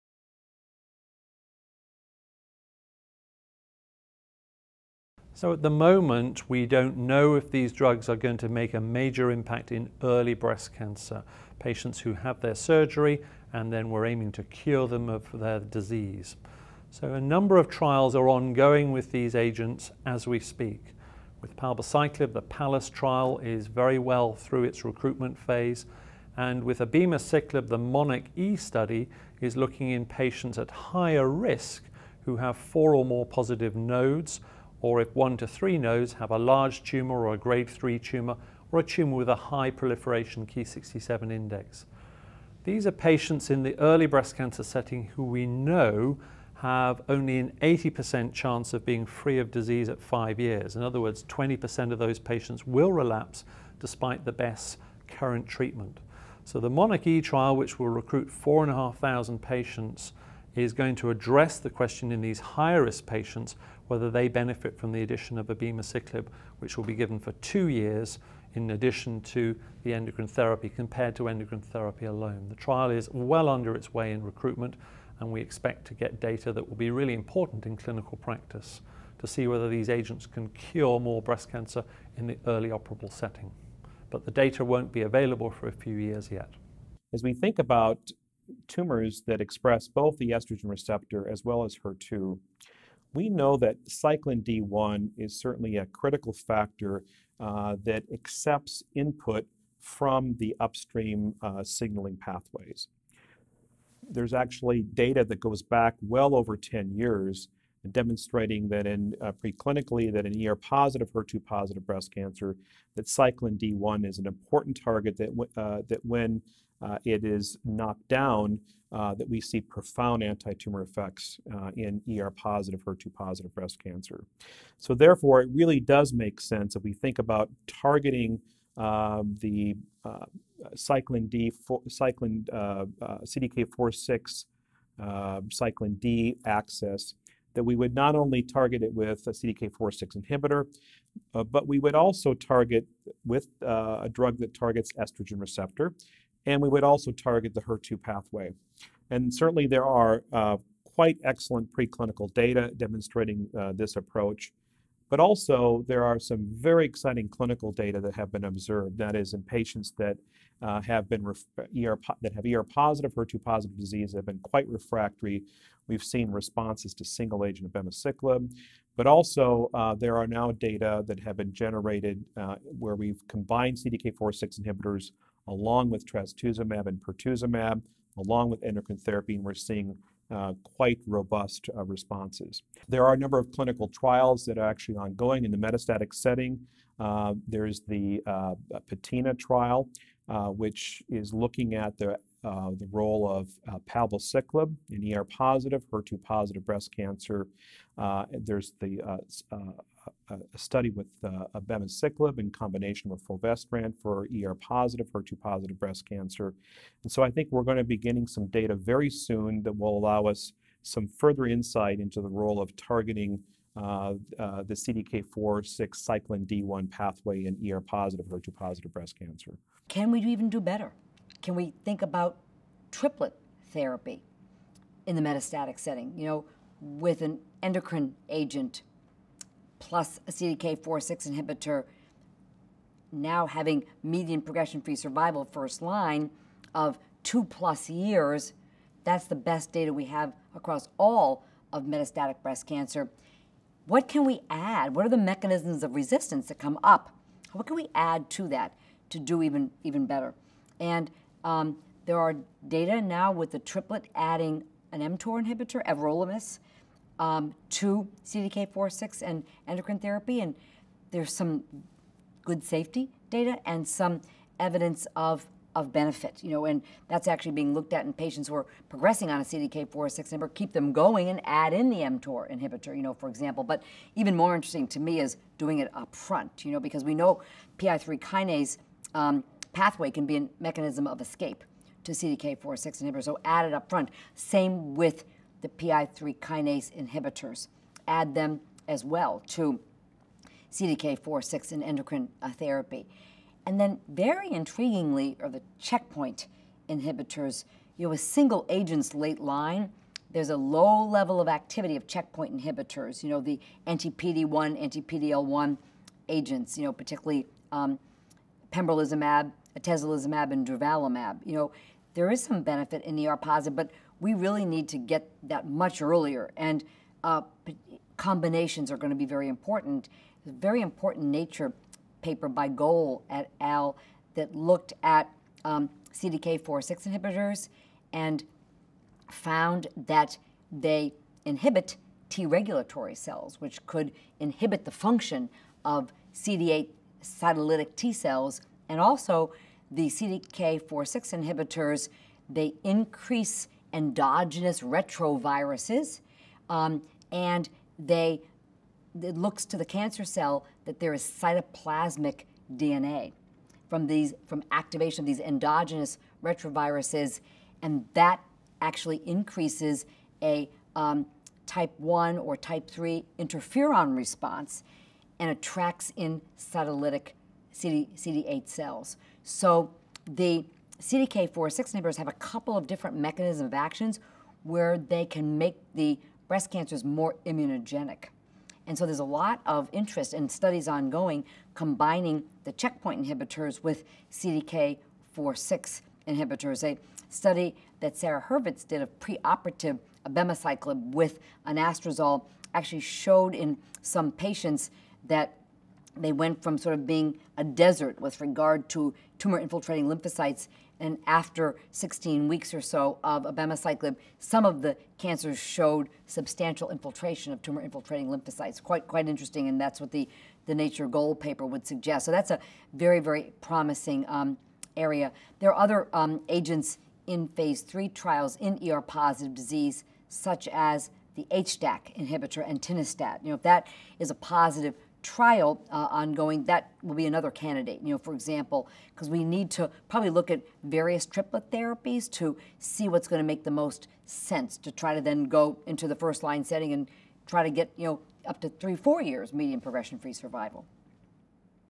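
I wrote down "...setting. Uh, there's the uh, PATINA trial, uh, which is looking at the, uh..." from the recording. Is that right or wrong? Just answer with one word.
right.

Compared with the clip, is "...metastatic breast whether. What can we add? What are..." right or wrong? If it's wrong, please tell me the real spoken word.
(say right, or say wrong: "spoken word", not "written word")
wrong: "cancer", not "whether".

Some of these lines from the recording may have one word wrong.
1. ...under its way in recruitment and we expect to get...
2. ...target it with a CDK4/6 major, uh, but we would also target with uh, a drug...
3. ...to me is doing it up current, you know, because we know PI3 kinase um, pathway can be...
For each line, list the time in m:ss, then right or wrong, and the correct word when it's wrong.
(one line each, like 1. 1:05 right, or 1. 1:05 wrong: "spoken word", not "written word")
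1. 1:13 right
2. 2:18 wrong: "inhibitor", not "major"
3. 4:34 wrong: "front", not "current".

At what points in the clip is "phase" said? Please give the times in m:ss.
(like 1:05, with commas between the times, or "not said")
0:25, 6:57.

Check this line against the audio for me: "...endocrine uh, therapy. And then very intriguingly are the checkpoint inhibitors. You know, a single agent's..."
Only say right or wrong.
right.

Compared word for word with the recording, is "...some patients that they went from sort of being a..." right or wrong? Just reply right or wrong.
right.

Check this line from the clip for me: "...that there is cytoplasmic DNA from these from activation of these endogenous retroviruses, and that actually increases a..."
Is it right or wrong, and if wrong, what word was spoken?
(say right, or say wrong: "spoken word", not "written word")
right.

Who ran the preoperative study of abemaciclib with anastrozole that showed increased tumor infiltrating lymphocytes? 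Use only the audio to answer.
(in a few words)
Sara Hurvitz.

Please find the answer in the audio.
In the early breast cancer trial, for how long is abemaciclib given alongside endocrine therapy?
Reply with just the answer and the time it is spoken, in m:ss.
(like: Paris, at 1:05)
two years, at 1:07.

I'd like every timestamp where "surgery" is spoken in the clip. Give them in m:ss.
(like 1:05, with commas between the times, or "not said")
0:12.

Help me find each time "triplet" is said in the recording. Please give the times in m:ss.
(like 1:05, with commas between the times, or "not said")
3:42, 4:13, 7:11.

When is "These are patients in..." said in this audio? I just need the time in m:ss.
0:42.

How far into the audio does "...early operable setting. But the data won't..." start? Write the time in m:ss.
1:22.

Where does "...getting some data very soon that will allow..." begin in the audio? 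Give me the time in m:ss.
3:27.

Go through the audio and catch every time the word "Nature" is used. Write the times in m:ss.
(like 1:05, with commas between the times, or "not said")
5:21, 6:50.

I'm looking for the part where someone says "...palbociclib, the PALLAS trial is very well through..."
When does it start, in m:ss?
0:21.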